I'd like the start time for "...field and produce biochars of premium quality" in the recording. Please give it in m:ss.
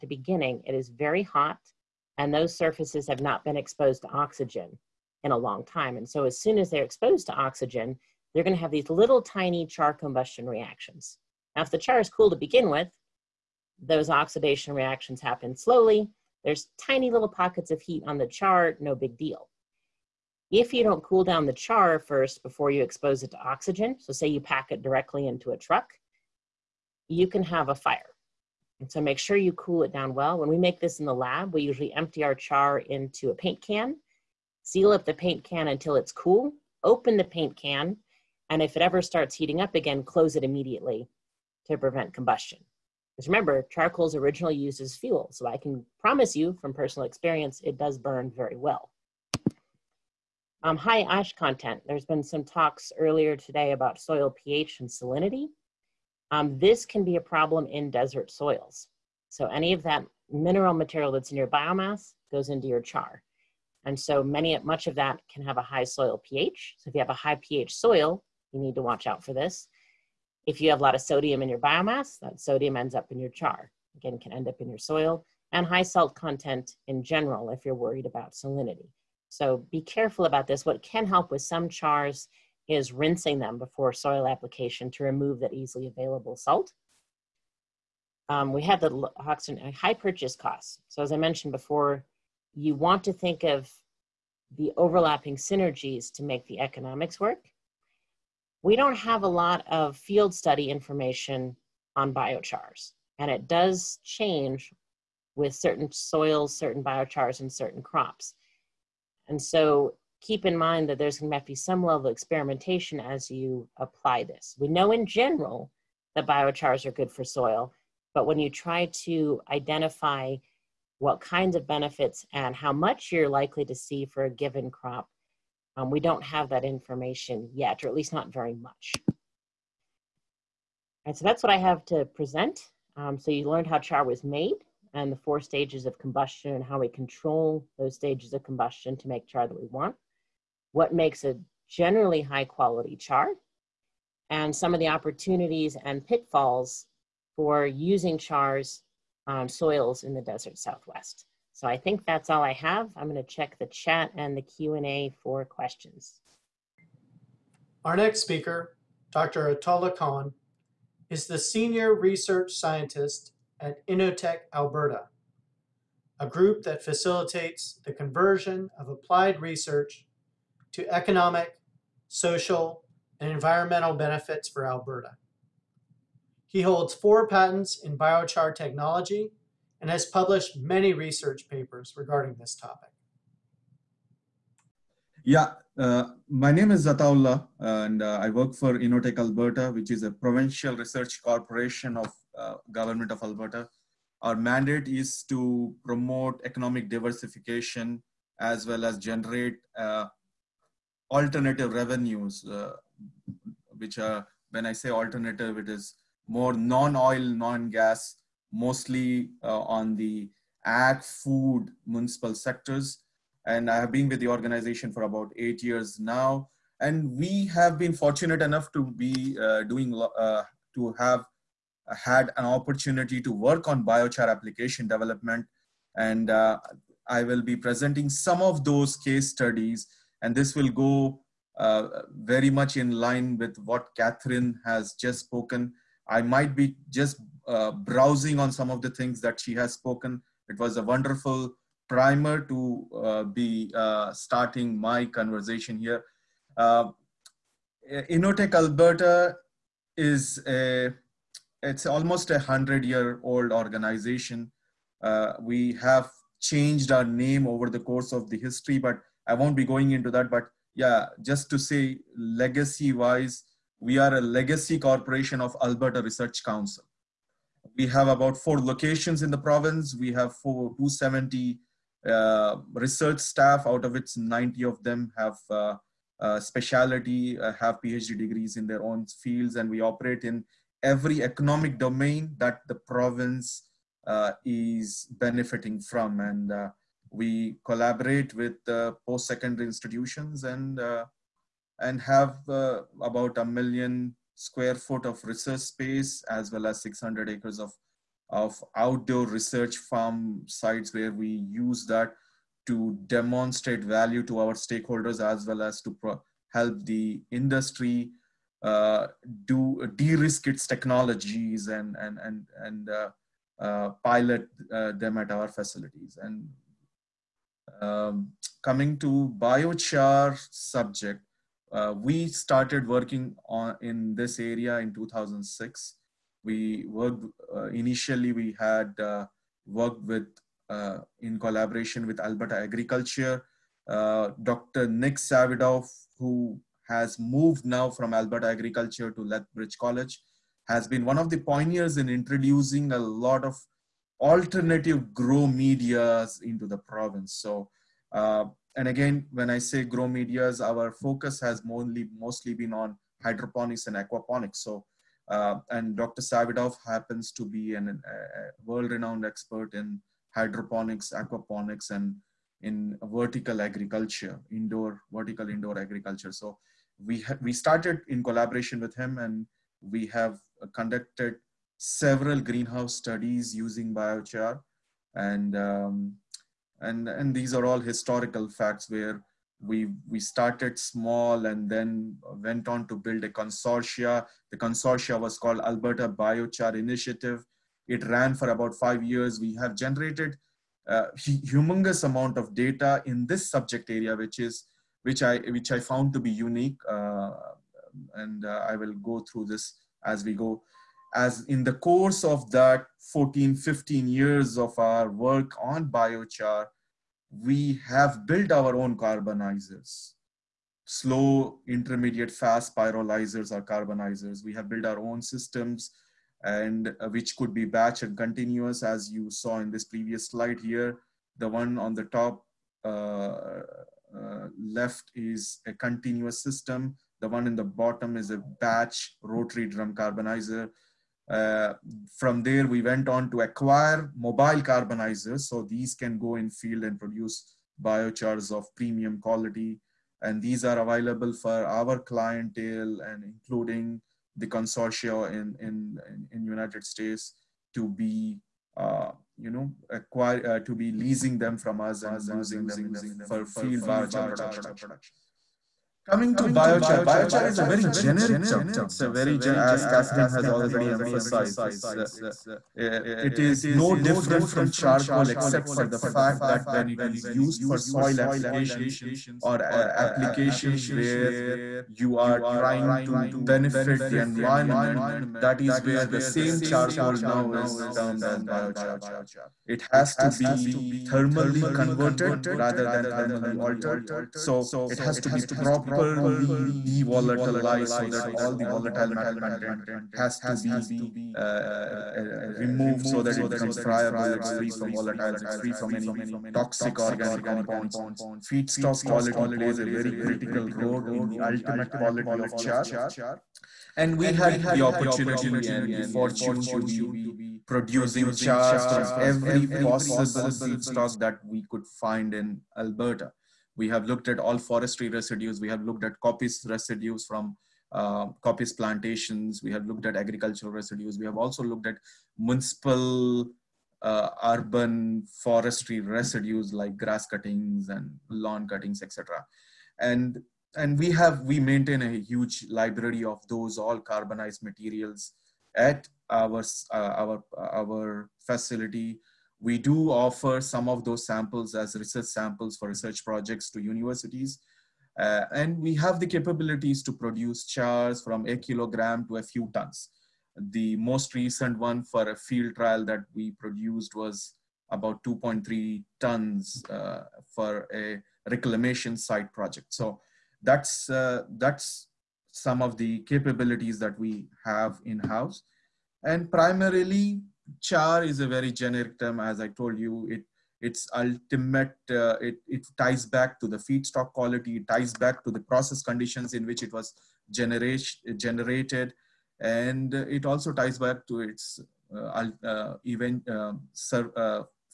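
7:16.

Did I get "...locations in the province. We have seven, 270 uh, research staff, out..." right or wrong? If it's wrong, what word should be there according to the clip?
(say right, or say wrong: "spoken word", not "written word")
wrong: "four", not "seven".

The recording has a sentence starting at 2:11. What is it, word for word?
And so that's what I have to present.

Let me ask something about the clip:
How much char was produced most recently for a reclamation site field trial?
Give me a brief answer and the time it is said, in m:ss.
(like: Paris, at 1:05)
2.3 tons, at 9:15.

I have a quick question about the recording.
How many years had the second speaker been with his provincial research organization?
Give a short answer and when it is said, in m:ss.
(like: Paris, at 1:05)
8, at 3:35.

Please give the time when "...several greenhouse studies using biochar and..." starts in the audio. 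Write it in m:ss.
6:11.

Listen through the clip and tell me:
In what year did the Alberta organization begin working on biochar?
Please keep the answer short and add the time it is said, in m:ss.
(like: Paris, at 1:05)
2006, at 5:24.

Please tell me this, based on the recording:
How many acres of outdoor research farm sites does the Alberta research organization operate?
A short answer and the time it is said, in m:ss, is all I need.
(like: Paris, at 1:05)
600, at 4:56.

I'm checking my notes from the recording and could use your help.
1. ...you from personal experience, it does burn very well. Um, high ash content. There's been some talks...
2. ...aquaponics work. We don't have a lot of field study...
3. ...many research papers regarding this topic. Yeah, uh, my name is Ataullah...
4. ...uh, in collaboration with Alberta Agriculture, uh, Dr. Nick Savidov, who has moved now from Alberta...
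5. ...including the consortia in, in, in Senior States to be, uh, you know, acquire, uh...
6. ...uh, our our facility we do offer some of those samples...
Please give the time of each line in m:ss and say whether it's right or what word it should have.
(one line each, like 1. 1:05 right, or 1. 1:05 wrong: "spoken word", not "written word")
1. 0:46 right
2. 1:36 wrong: "economics", not "aquaponics"
3. 3:00 right
4. 5:30 right
5. 7:23 wrong: "United", not "Senior"
6. 8:56 right.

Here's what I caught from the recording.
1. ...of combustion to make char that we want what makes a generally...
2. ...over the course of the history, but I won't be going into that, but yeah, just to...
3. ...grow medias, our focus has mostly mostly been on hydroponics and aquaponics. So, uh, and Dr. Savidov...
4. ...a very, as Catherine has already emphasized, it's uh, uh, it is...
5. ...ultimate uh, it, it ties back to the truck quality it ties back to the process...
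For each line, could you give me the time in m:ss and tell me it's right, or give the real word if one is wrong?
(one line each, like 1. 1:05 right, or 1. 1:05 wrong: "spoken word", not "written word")
1. 2:18 right
2. 4:17 right
3. 5:49 right
4. 7:39 right
5. 9:31 wrong: "feedstock", not "truck".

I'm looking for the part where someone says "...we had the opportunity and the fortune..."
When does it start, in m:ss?
8:24.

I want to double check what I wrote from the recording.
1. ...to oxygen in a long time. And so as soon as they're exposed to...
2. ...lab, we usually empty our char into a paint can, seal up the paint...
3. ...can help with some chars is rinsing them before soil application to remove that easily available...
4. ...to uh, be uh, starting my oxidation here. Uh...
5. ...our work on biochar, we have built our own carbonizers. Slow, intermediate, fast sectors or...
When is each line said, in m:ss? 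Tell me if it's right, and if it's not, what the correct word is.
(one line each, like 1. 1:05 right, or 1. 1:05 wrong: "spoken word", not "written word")
1. 0:04 right
2. 0:31 right
3. 1:20 right
4. 4:02 wrong: "conversation", not "oxidation"
5. 6:44 wrong: "pyrolyzers", not "sectors".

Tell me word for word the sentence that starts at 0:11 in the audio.
Now, if the char is cool to begin with, those oxidation reactions happen slowly.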